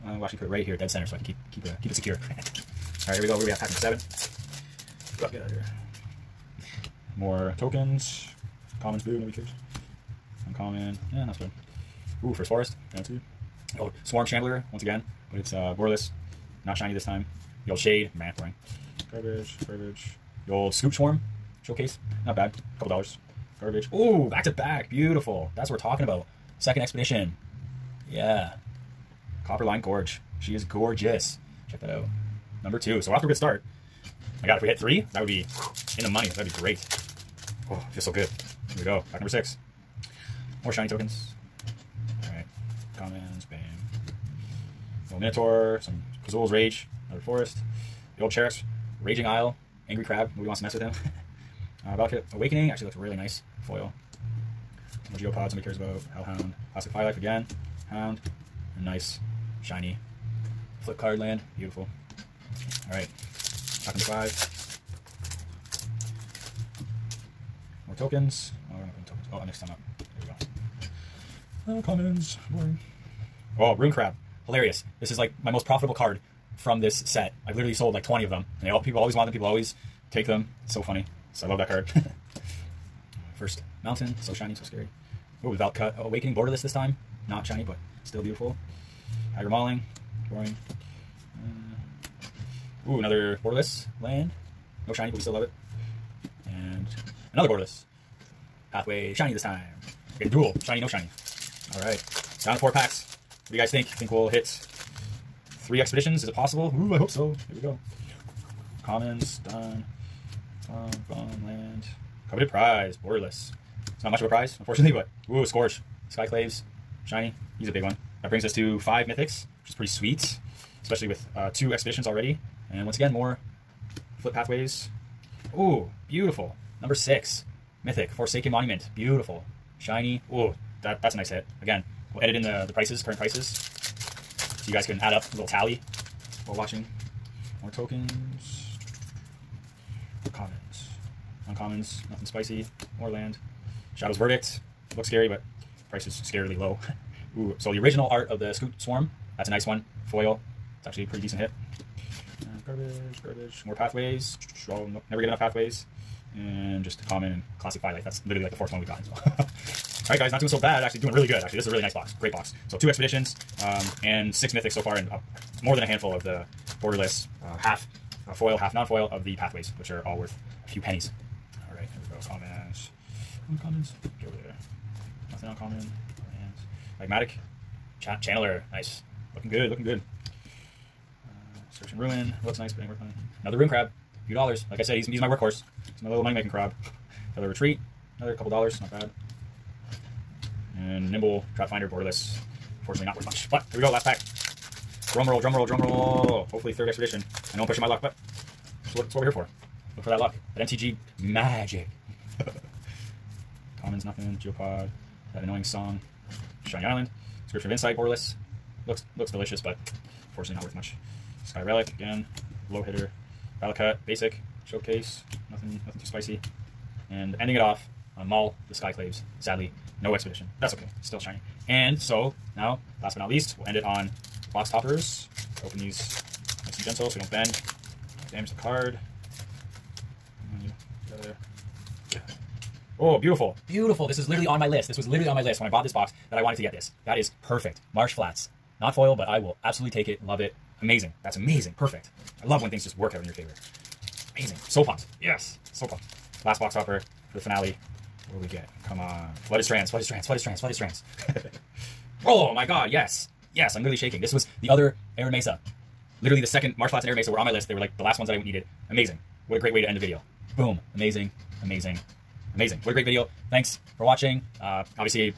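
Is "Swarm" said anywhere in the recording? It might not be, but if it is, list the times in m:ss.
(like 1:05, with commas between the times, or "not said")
0:14, 0:20, 2:28.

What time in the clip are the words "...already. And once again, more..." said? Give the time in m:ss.
2:02.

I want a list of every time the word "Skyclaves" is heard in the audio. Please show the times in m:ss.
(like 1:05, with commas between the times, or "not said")
1:56, 3:38.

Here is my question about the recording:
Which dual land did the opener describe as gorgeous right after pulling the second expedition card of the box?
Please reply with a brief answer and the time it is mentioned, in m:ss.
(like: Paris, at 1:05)
Copperline Gorge, at 0:29.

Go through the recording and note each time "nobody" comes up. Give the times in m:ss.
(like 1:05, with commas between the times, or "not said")
0:09, 0:50.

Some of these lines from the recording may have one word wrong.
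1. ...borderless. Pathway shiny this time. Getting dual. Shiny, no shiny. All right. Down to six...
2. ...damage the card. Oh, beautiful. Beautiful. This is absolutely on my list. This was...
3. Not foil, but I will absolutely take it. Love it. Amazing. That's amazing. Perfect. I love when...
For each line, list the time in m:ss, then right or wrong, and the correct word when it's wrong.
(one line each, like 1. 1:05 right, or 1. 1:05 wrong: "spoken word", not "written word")
1. 1:37 wrong: "four", not "six"
2. 3:48 wrong: "literally", not "absolutely"
3. 3:58 right.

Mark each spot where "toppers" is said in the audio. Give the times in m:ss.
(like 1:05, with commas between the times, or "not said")
3:44, 4:06.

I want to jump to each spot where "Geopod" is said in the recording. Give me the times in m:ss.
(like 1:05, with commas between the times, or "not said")
0:55, 3:24.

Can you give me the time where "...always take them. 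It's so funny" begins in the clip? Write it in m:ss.
1:19.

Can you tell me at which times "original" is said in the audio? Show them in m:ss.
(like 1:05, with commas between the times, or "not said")
2:27.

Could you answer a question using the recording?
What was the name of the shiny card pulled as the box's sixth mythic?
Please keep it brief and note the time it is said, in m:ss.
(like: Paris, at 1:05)
Forsaken Monument, at 2:08.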